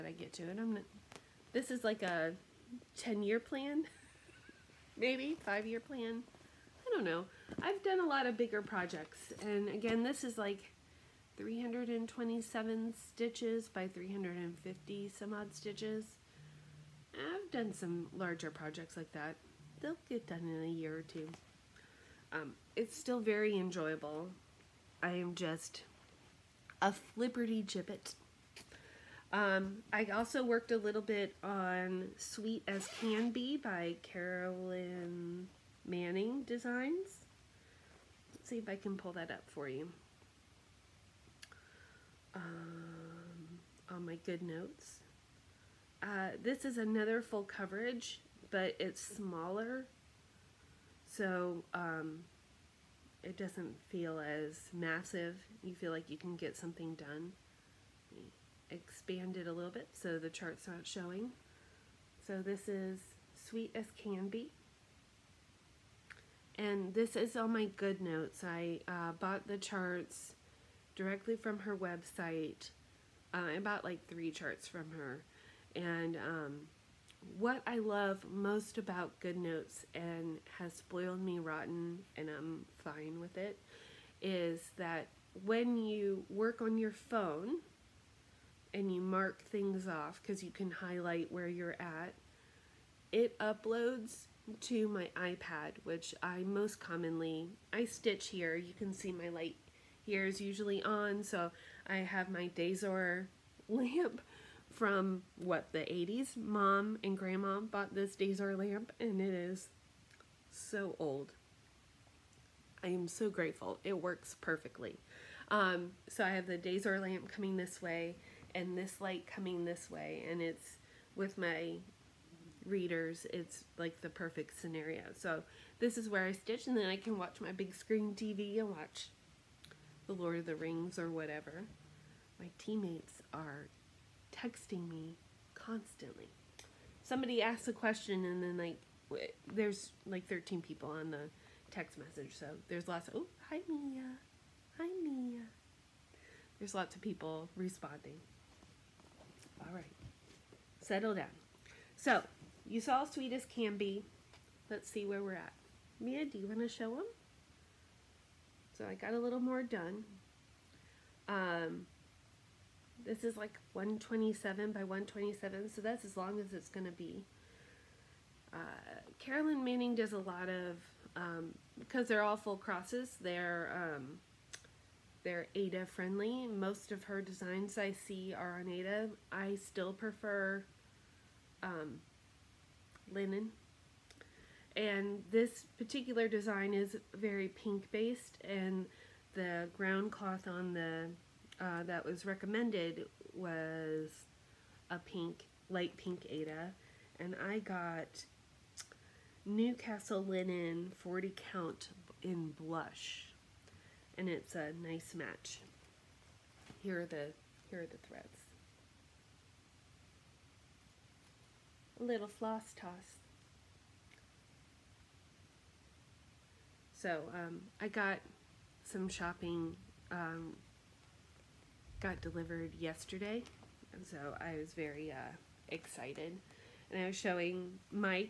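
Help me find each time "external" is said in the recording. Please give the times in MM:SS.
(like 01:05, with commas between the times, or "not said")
not said.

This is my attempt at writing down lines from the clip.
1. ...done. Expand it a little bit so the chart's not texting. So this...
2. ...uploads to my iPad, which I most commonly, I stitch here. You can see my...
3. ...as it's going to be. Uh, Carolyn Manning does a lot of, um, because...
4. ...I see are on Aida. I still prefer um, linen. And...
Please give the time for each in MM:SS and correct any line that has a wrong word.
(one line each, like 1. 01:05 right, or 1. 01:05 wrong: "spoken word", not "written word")
1. 00:56 wrong: "showing", not "texting"
2. 01:33 right
3. 02:46 right
4. 02:57 right.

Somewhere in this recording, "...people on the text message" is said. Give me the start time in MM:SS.
02:20.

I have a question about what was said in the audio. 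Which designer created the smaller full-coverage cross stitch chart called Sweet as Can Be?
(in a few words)
Carolyn Manning Designs.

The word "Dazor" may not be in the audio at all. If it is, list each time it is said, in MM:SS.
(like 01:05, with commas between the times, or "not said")
01:42, 01:48, 01:56.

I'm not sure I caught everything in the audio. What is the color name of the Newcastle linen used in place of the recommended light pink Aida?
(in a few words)
Blush.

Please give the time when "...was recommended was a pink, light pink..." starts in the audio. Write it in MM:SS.
03:12.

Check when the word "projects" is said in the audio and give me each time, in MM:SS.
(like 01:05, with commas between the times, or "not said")
00:08, 00:18.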